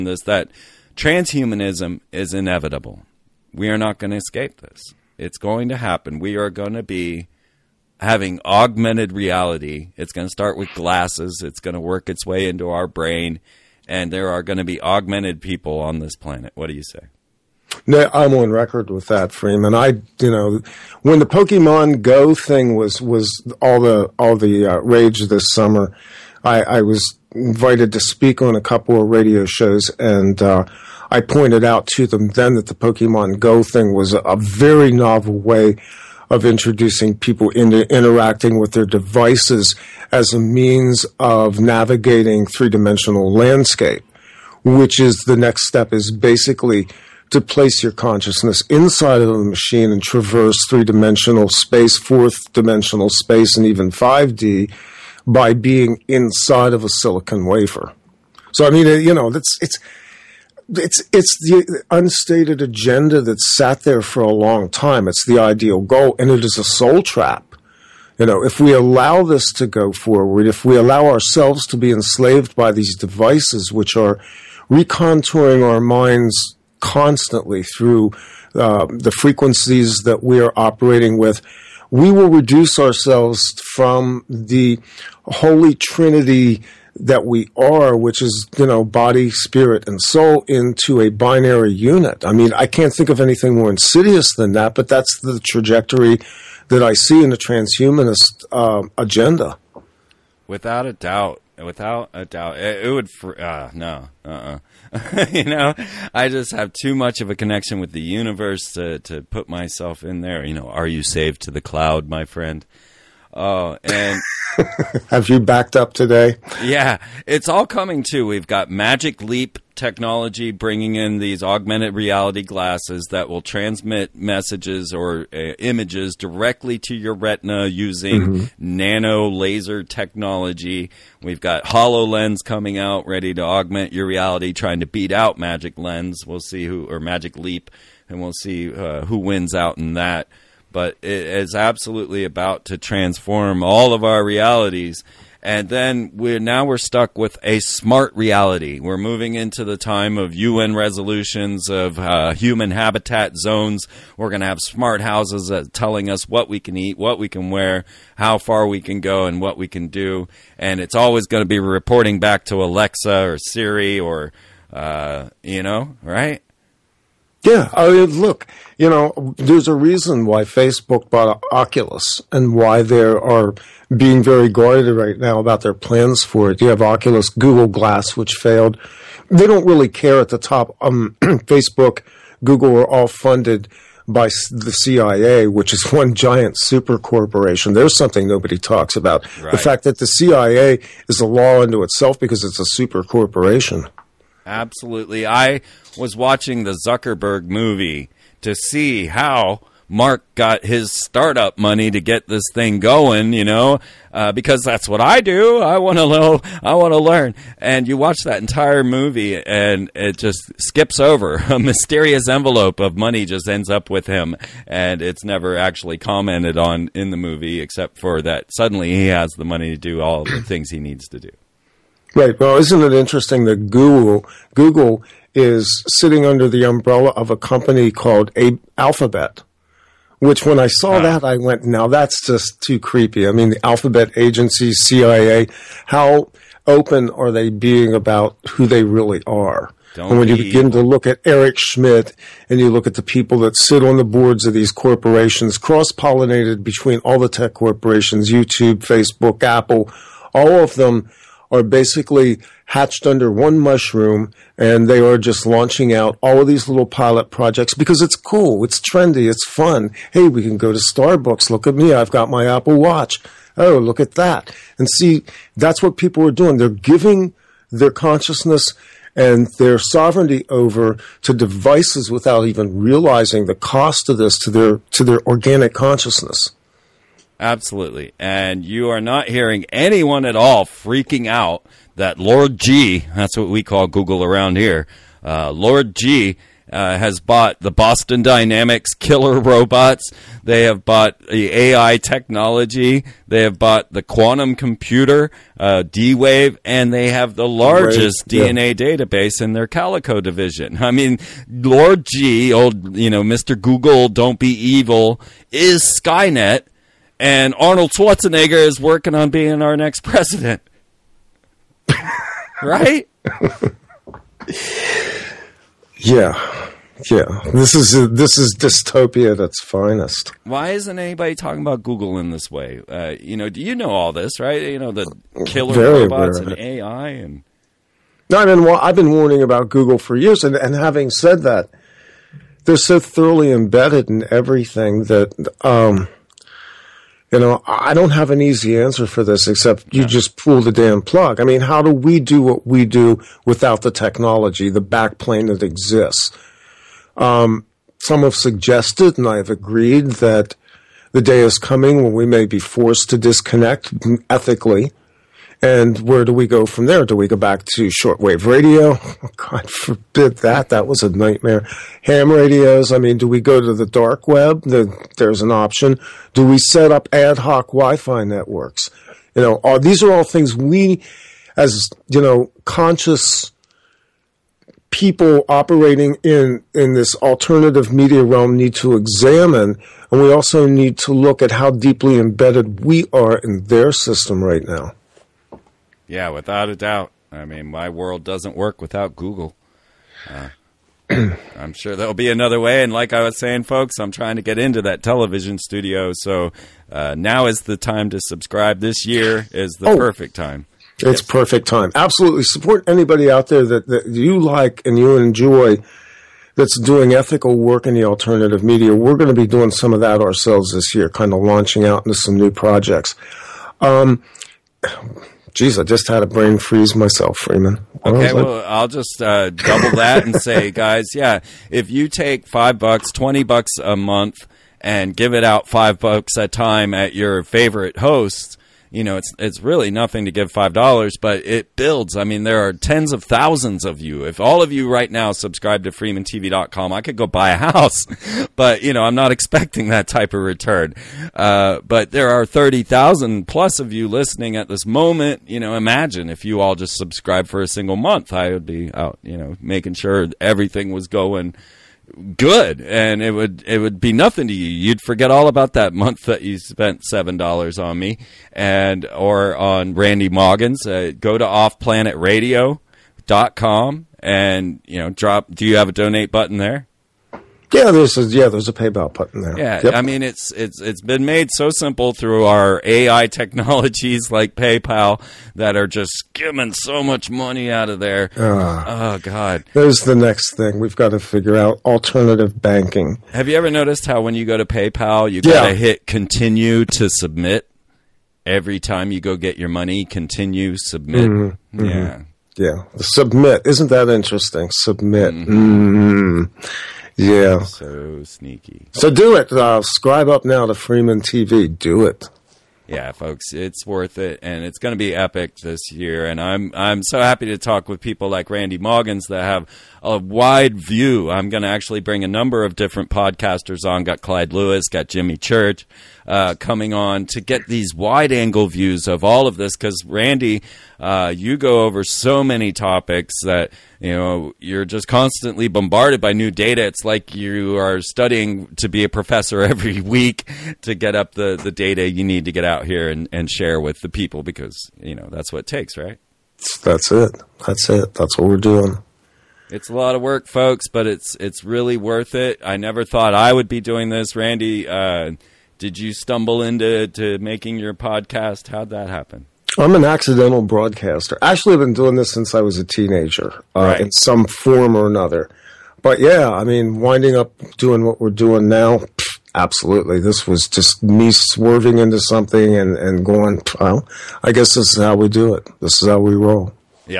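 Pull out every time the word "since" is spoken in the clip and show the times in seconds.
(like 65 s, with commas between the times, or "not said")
552 s.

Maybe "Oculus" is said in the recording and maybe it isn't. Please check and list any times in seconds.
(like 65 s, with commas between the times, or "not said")
171 s, 176 s.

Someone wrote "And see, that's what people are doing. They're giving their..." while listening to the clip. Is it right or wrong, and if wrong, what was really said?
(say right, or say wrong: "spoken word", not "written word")
right.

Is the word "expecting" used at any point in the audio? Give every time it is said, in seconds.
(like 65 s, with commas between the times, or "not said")
439 s.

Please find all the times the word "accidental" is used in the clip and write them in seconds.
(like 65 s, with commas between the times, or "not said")
550 s.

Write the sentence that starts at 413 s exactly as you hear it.
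Um, Jeez, I just had a brain freeze myself, Freeman.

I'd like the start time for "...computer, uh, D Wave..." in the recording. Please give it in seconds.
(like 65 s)
294 s.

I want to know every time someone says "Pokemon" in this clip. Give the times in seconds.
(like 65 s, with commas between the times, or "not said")
21 s, 32 s.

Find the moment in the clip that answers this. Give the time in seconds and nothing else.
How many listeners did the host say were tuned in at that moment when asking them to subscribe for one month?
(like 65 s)
442 s.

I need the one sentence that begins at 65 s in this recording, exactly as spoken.
It's the ideal goal, and it is a soul trap.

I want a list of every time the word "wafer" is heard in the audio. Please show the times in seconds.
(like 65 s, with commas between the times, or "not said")
57 s.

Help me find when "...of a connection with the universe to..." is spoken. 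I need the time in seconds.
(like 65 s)
107 s.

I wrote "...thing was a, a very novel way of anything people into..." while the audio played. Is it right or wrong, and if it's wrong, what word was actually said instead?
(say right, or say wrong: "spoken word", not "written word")
wrong: "introducing", not "anything".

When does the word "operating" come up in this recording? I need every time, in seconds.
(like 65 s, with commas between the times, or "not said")
80 s, 375 s.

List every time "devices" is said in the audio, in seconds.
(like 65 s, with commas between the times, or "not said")
38 s, 72 s, 271 s.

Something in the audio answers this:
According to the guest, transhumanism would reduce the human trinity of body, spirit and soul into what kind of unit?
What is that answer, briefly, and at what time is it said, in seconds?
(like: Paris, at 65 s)
binary unit, at 91 s.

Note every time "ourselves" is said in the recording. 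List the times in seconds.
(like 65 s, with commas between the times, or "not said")
71 s, 82 s, 410 s.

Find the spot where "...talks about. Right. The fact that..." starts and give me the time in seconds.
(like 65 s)
188 s.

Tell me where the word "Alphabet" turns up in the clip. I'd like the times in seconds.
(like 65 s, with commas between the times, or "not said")
228 s, 233 s.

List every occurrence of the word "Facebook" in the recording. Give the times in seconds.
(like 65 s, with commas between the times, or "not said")
170 s, 181 s, 248 s.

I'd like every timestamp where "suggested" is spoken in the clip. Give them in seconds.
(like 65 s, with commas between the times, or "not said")
348 s.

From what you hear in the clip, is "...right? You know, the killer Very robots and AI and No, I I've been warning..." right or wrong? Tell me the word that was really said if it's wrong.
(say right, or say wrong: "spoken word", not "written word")
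right.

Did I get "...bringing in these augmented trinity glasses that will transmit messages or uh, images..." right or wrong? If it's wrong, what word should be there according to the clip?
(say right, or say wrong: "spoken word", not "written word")
wrong: "reality", not "trinity".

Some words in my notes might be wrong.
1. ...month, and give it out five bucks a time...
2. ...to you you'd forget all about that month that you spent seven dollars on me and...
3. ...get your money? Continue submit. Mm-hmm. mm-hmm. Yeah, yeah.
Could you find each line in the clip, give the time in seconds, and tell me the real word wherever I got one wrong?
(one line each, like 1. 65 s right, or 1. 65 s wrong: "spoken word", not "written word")
1. 423 s right
2. 454 s right
3. 489 s right.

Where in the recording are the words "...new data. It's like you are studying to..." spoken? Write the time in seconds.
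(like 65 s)
526 s.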